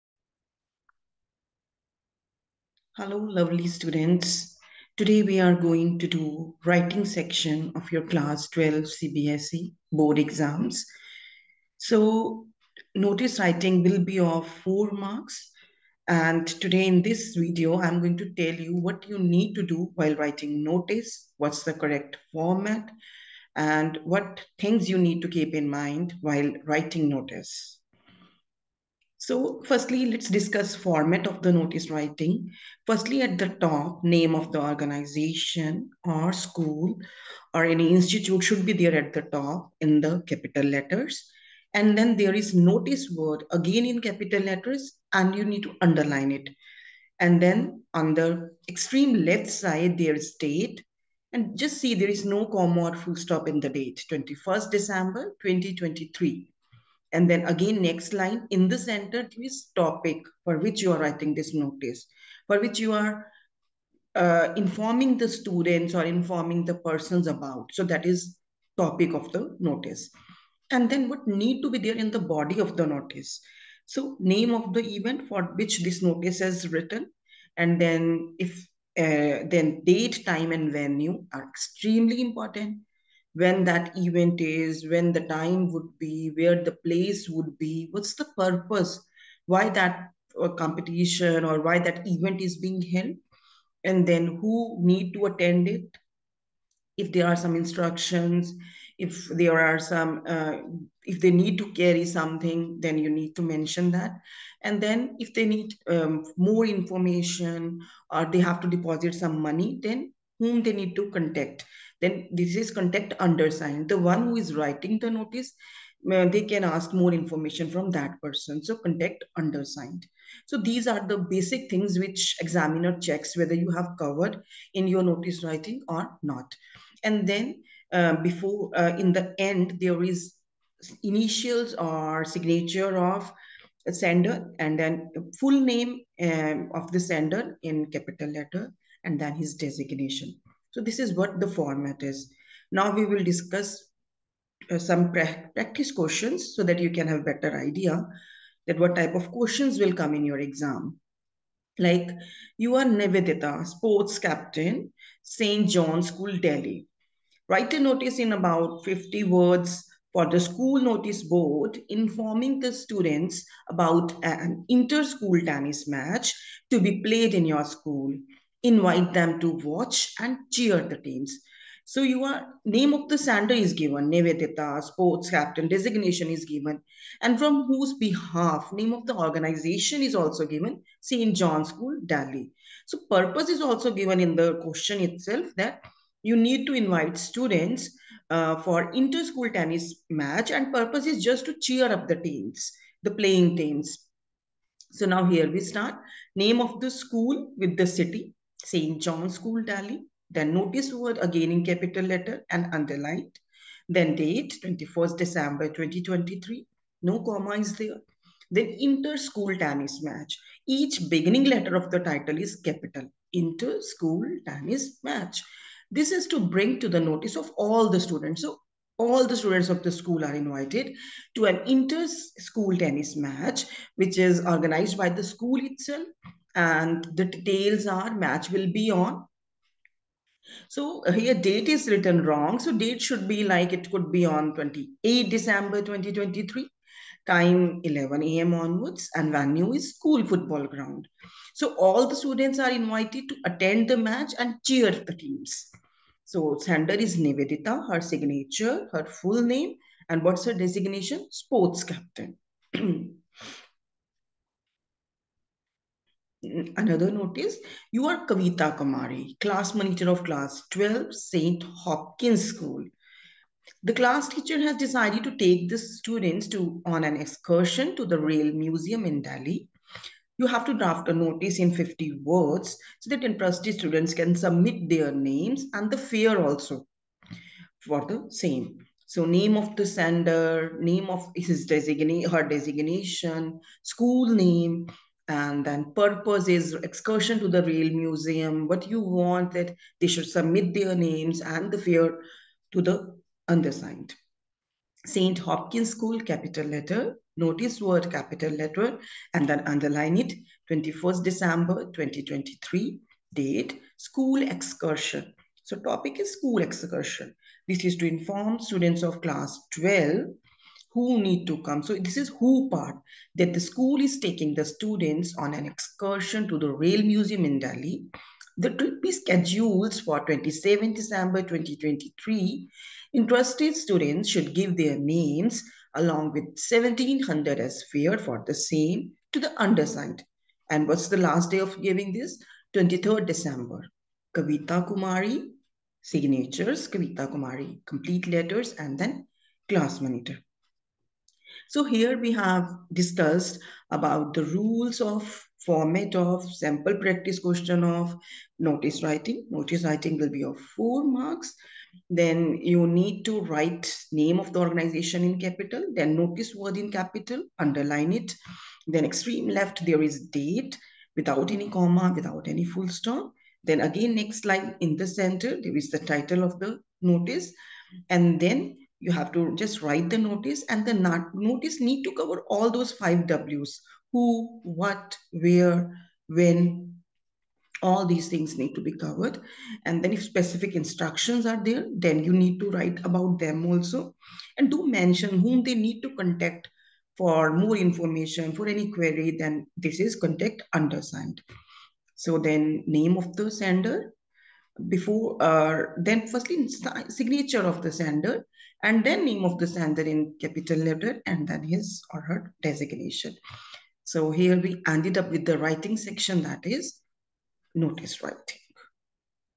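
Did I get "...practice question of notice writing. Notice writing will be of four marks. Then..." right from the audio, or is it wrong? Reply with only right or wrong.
right.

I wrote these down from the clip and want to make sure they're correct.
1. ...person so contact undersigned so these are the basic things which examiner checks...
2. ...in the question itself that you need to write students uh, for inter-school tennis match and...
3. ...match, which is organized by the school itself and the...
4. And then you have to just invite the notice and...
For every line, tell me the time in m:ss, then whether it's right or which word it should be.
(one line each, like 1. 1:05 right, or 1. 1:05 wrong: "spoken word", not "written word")
1. 1:58 right
2. 3:04 wrong: "invite", not "write"
3. 3:43 right
4. 6:08 wrong: "write", not "invite".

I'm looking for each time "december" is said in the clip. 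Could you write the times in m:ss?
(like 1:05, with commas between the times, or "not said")
0:54, 3:25, 3:55, 5:01, 5:20, 5:33.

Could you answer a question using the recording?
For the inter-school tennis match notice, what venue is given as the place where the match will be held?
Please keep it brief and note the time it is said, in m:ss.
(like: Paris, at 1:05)
school football ground, at 3:59.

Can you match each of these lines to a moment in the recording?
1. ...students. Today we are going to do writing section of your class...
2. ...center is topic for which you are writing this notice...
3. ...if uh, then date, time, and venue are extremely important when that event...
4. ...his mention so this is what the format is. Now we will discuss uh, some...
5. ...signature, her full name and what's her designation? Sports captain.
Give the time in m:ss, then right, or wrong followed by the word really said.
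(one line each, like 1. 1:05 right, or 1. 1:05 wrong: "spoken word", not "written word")
1. 0:03 right
2. 0:58 right
3. 1:18 right
4. 2:19 wrong: "designation", not "mention"
5. 4:08 right.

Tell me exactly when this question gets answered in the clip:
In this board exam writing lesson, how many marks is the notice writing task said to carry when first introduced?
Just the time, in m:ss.
0:14.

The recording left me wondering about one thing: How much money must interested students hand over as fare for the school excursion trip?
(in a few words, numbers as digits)
1700.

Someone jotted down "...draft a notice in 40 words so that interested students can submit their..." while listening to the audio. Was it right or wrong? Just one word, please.
wrong.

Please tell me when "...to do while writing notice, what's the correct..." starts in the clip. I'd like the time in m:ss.
0:19.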